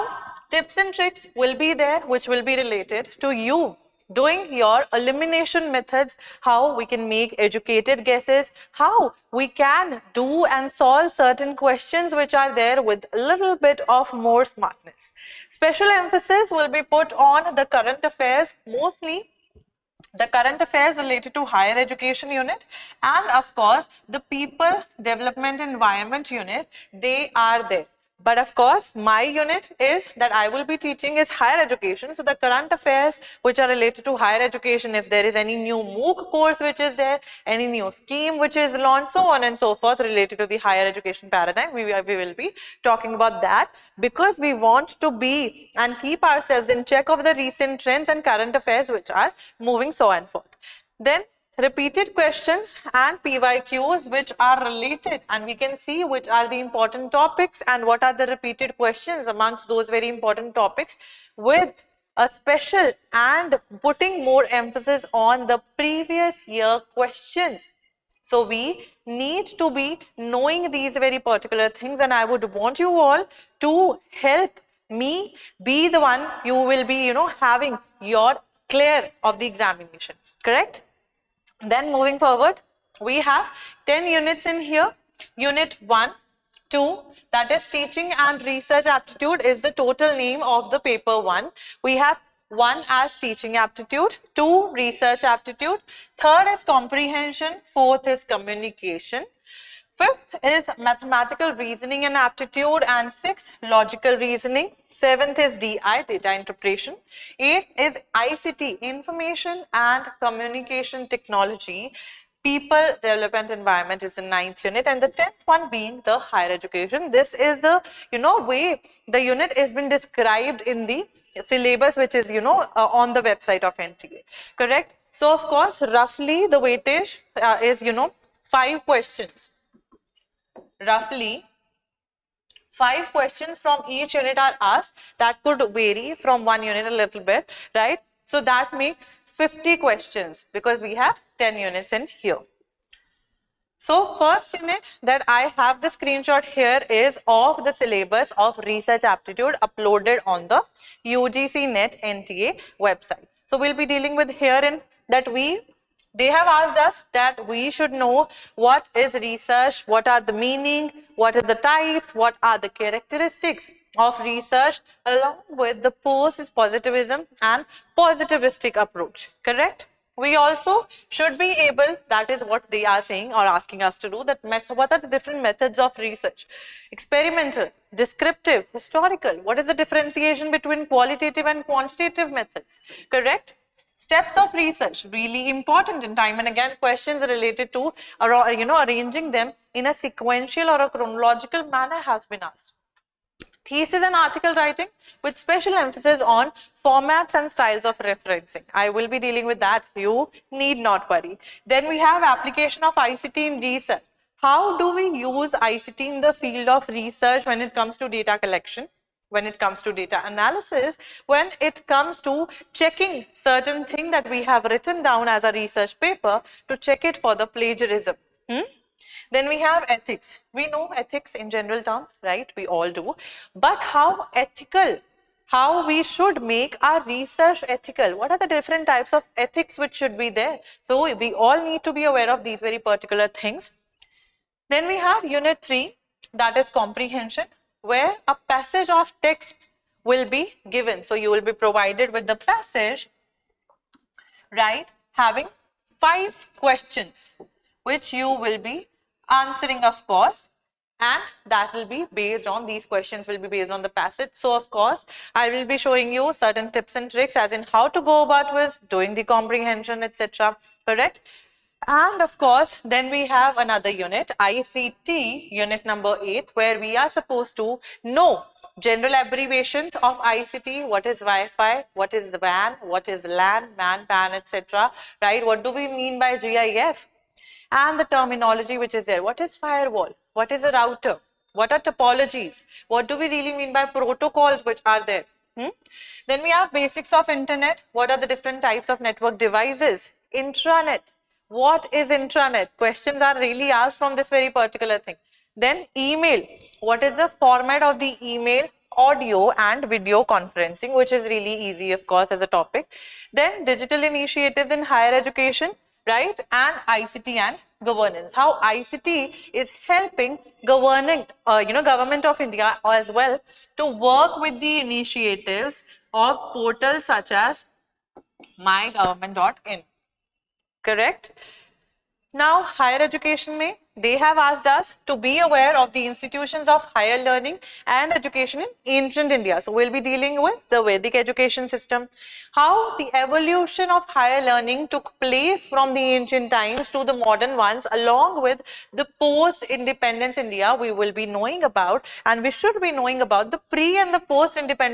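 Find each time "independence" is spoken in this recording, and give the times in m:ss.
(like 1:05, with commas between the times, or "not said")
5:39, 5:44.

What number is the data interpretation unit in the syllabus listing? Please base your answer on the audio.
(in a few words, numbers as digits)
7.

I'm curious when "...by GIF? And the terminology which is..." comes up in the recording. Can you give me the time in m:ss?
4:36.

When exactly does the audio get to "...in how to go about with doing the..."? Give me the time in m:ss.
4:17.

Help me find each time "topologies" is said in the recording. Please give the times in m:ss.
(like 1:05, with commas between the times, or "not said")
4:41.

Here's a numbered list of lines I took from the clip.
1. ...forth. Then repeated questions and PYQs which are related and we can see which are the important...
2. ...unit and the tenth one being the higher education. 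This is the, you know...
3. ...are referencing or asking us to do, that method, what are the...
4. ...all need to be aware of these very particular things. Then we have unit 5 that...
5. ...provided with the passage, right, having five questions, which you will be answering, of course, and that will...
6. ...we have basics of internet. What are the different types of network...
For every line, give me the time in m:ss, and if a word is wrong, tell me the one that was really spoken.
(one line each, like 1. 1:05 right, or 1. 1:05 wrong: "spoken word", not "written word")
1. 0:50 right
2. 1:54 right
3. 2:52 wrong: "saying", not "referencing"
4. 3:51 wrong: "3", not "5"
5. 4:01 right
6. 4:46 right.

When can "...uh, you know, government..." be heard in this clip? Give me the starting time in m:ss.
5:11.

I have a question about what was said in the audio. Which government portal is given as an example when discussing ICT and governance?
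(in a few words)
mygovernment.in.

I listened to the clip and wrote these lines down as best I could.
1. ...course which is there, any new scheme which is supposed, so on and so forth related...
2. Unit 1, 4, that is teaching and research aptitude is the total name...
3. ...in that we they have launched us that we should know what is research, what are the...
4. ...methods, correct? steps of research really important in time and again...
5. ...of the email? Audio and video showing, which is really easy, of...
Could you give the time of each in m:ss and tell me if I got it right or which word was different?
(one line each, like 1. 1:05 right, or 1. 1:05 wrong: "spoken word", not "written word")
1. 0:36 wrong: "launched", not "supposed"
2. 1:25 wrong: "2", not "4"
3. 2:34 wrong: "asked", not "launched"
4. 3:02 right
5. 4:57 wrong: "conferencing", not "showing".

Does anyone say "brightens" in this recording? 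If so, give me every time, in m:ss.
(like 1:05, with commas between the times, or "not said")
not said.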